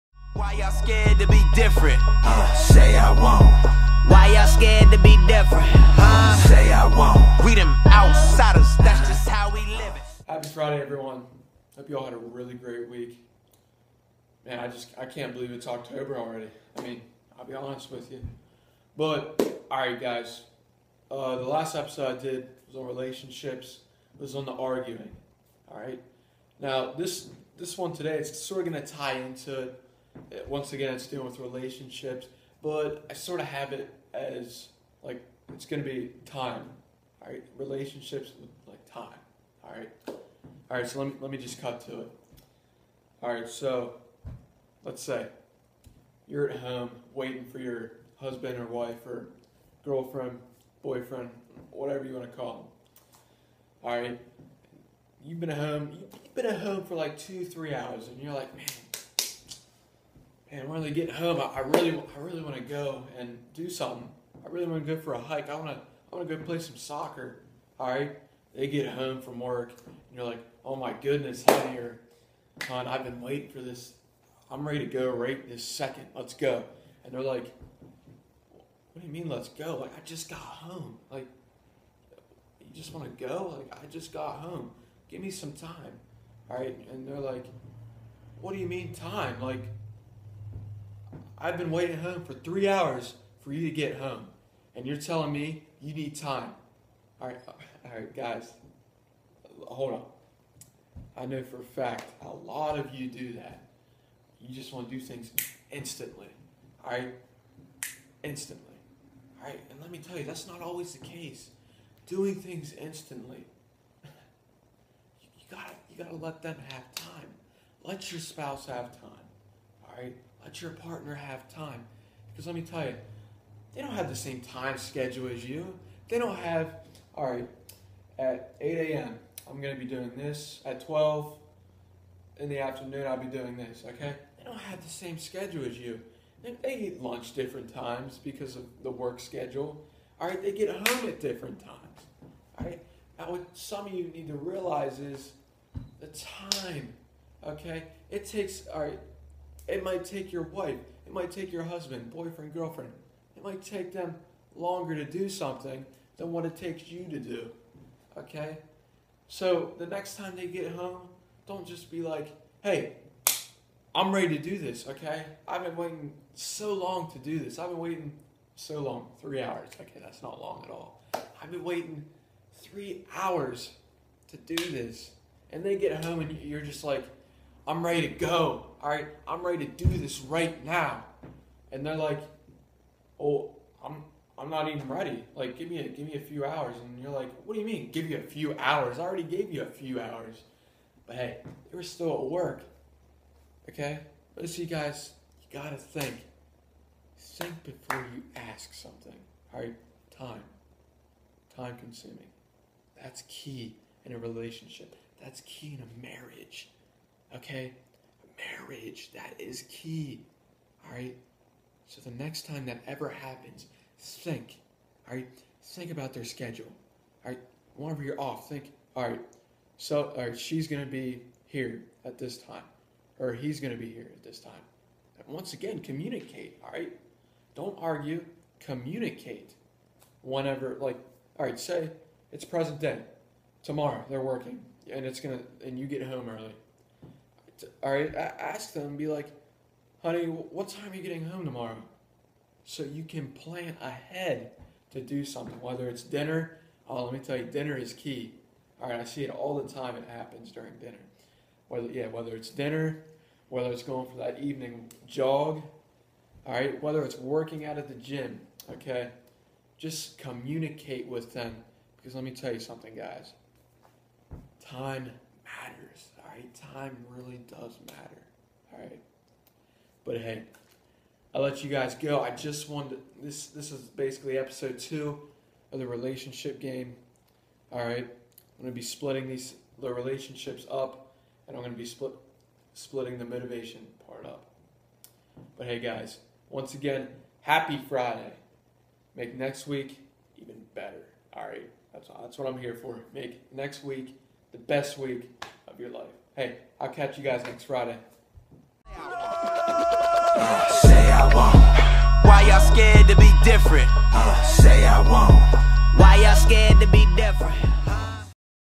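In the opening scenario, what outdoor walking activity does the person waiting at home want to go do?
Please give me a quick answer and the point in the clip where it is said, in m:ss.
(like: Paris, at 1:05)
hike, at 1:04.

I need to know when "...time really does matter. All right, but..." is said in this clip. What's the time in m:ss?
4:26.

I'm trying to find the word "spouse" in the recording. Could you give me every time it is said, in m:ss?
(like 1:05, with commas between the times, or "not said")
1:58.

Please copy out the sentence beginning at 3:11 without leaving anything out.
But hey, they were still at work.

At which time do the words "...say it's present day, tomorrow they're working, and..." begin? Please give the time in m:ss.
3:51.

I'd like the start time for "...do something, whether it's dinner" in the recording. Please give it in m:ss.
4:05.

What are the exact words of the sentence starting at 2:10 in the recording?
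At 12 in the afternoon, I'll be doing this, okay?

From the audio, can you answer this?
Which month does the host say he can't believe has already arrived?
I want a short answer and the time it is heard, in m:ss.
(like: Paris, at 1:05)
October, at 0:15.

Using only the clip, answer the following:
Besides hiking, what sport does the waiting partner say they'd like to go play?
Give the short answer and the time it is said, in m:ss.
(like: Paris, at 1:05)
soccer, at 1:06.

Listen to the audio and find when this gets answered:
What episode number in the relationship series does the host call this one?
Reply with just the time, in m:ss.
4:34.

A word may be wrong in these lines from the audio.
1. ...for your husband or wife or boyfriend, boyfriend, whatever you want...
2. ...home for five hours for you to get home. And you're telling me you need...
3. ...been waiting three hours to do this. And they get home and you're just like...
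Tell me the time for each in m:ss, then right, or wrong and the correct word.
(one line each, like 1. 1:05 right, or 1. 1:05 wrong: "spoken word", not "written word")
1. 0:47 wrong: "girlfriend", not "boyfriend"
2. 1:31 wrong: "three", not "five"
3. 2:51 right.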